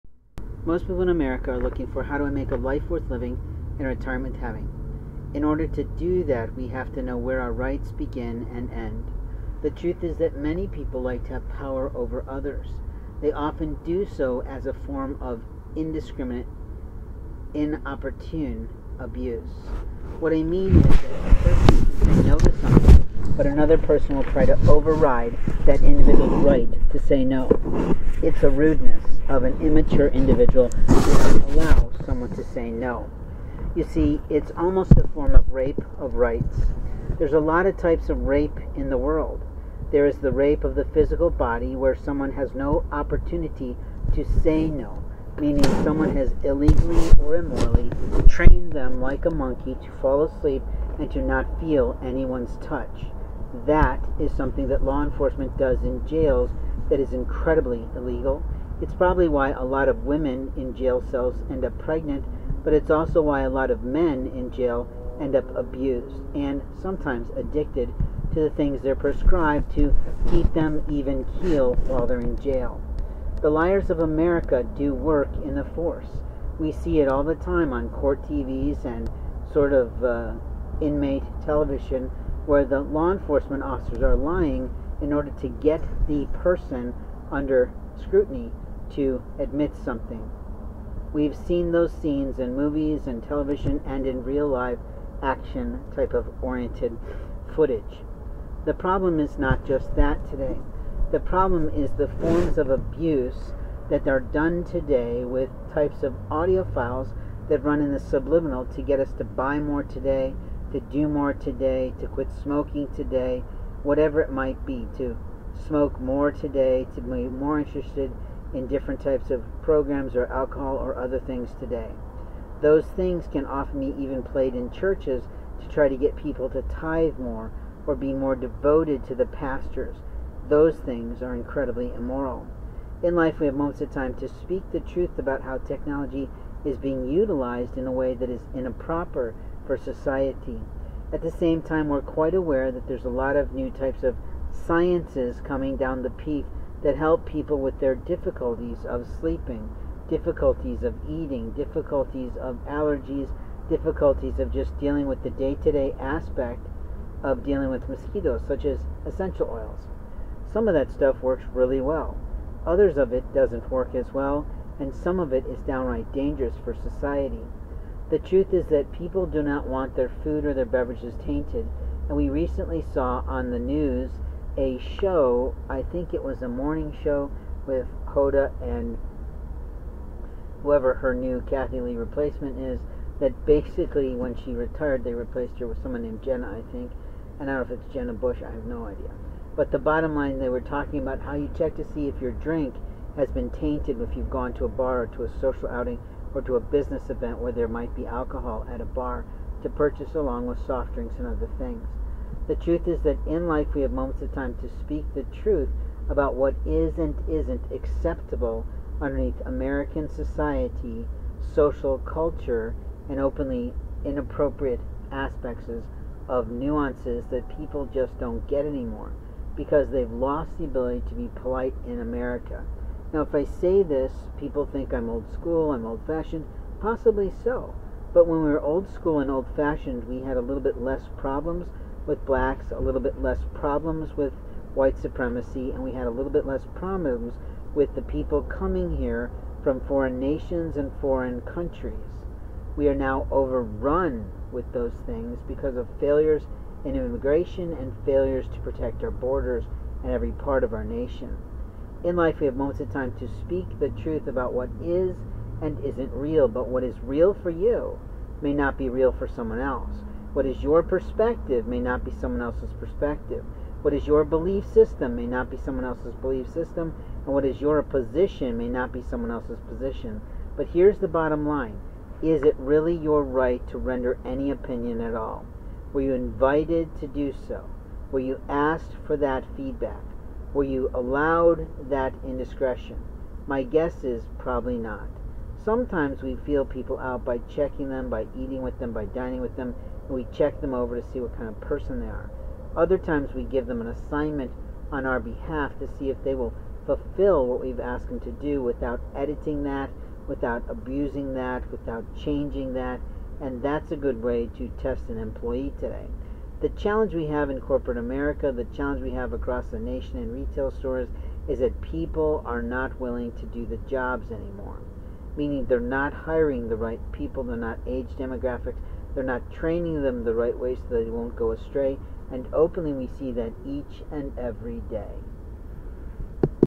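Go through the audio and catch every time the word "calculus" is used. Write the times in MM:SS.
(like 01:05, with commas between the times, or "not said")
not said.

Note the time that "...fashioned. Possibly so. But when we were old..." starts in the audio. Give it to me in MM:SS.
03:46.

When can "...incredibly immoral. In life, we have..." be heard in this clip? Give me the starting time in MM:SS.
02:11.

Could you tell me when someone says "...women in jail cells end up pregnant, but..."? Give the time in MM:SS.
01:00.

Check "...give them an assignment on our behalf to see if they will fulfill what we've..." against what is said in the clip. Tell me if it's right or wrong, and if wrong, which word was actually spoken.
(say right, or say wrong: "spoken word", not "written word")
right.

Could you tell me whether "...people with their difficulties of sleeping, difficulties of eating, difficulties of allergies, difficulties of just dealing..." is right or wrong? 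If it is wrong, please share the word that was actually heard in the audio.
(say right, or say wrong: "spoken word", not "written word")
right.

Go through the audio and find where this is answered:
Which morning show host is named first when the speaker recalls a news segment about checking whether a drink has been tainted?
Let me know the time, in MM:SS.
02:58.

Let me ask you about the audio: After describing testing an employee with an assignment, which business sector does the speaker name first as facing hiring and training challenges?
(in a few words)
corporate America.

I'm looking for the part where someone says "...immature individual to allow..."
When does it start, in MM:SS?
00:29.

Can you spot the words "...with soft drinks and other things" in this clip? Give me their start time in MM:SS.
03:20.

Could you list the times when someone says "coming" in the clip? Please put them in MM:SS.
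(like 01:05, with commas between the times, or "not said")
02:25, 03:58.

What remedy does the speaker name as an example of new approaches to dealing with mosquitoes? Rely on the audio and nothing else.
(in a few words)
essential oils.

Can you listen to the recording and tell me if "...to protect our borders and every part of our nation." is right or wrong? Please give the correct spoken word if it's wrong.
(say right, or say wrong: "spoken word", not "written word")
right.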